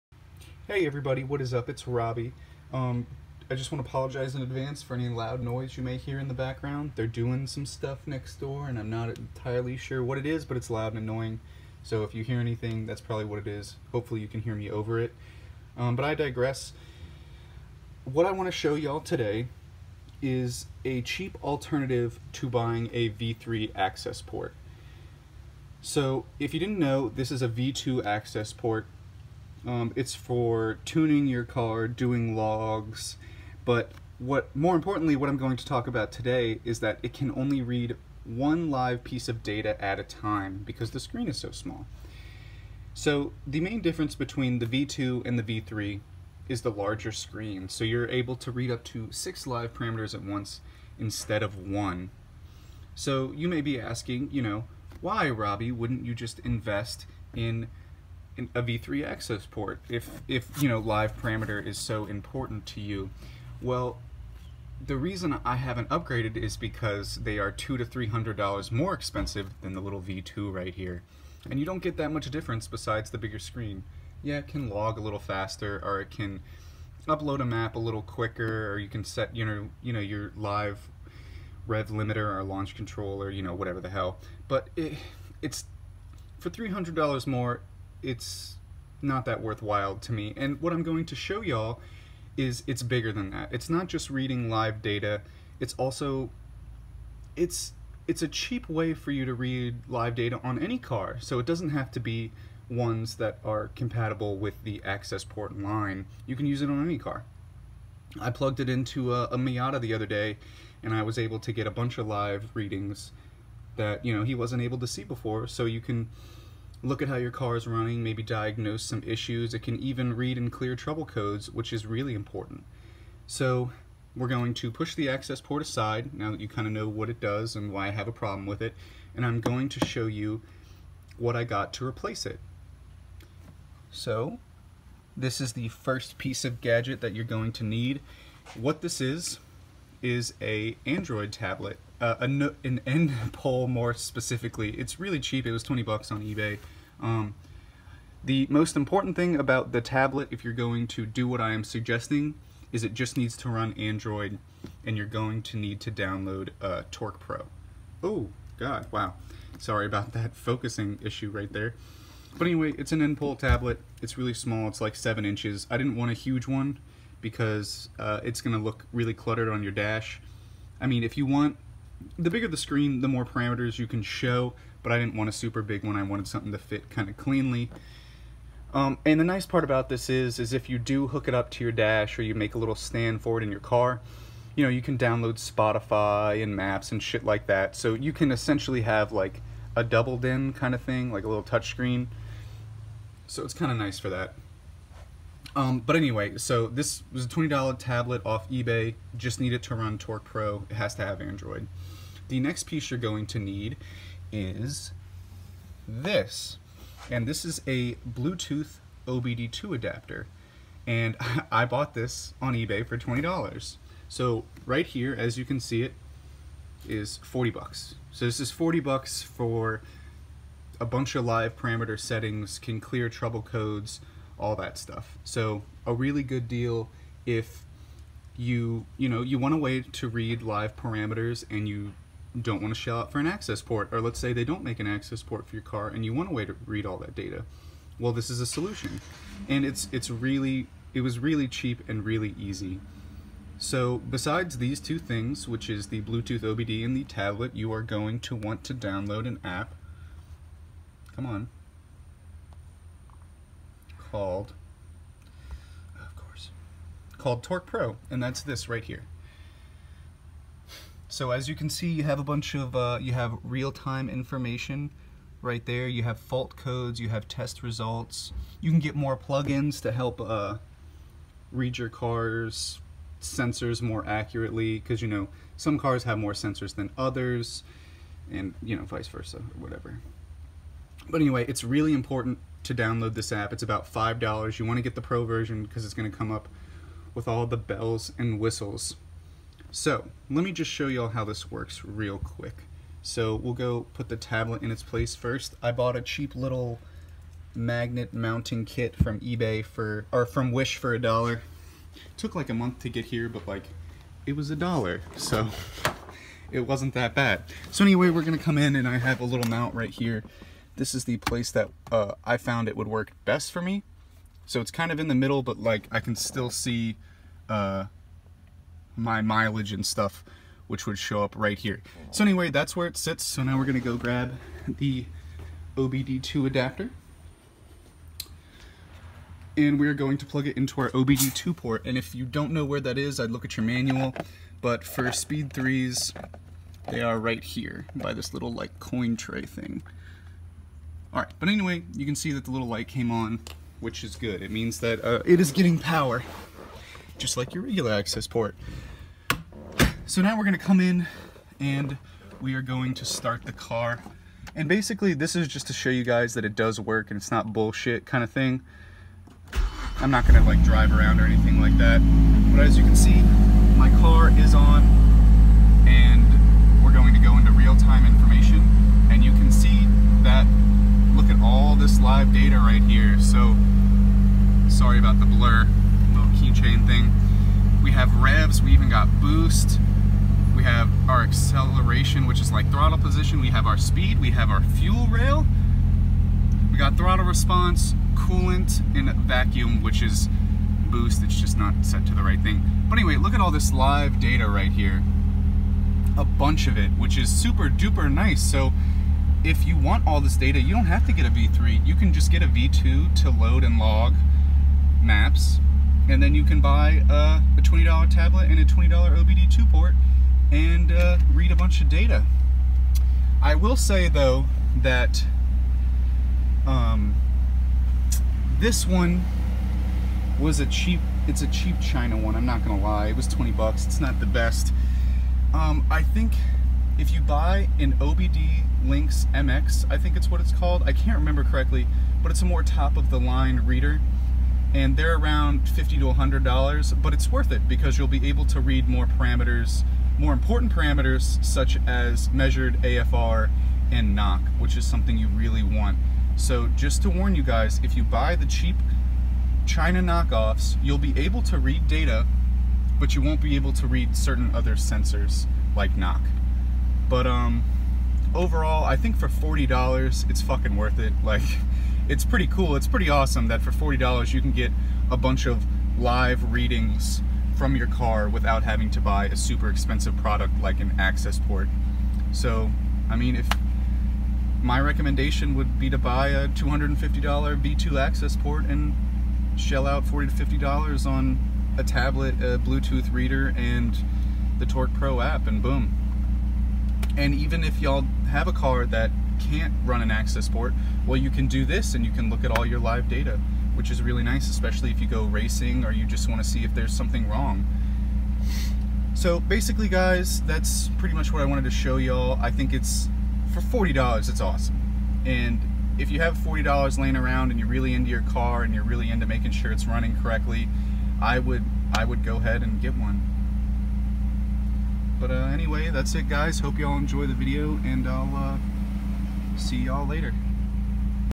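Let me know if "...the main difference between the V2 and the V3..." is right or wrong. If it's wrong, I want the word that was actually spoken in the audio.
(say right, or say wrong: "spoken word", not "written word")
right.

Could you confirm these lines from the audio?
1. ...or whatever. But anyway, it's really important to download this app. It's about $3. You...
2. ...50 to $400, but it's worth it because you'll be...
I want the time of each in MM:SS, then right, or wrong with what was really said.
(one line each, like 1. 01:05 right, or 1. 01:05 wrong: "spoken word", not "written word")
1. 04:39 wrong: "5", not "3"
2. 07:15 wrong: "100", not "400".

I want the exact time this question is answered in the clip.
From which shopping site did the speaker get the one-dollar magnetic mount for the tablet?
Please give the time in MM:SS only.
05:00.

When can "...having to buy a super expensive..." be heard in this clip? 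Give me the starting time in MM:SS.
07:48.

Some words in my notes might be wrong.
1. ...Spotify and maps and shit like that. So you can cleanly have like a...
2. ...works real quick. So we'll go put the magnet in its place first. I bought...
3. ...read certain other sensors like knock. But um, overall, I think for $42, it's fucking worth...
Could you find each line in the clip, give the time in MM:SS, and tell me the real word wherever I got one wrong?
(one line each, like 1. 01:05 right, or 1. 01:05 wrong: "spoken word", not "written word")
1. 03:05 wrong: "essentially", not "cleanly"
2. 04:51 wrong: "tablet", not "magnet"
3. 07:33 wrong: "40", not "42".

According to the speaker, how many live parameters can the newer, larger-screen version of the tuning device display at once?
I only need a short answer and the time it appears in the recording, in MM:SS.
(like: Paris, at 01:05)
6, at 00:49.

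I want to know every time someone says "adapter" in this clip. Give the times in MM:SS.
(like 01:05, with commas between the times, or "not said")
03:29, 05:26.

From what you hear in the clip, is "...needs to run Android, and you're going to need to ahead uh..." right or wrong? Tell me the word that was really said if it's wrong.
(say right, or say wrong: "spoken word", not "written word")
wrong: "download", not "ahead".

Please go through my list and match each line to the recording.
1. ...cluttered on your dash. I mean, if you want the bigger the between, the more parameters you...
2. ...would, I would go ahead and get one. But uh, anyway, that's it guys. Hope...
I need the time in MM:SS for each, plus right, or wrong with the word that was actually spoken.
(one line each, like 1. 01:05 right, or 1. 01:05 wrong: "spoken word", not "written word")
1. 02:49 wrong: "screen", not "between"
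2. 08:31 right.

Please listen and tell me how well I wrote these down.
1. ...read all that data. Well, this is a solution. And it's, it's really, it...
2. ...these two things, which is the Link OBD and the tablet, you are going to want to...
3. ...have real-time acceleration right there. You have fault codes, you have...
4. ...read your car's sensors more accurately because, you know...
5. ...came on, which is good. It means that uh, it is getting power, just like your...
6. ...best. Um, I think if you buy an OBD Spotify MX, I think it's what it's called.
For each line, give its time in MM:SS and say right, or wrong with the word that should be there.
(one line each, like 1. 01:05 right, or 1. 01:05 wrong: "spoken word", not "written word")
1. 03:56 right
2. 04:04 wrong: "Bluetooth", not "Link"
3. 04:23 wrong: "information", not "acceleration"
4. 04:31 right
5. 05:42 right
6. 07:04 wrong: "Link", not "Spotify".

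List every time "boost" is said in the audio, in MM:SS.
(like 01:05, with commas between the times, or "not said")
06:19, 06:30.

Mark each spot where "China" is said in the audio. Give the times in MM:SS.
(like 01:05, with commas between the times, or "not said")
07:01, 07:29.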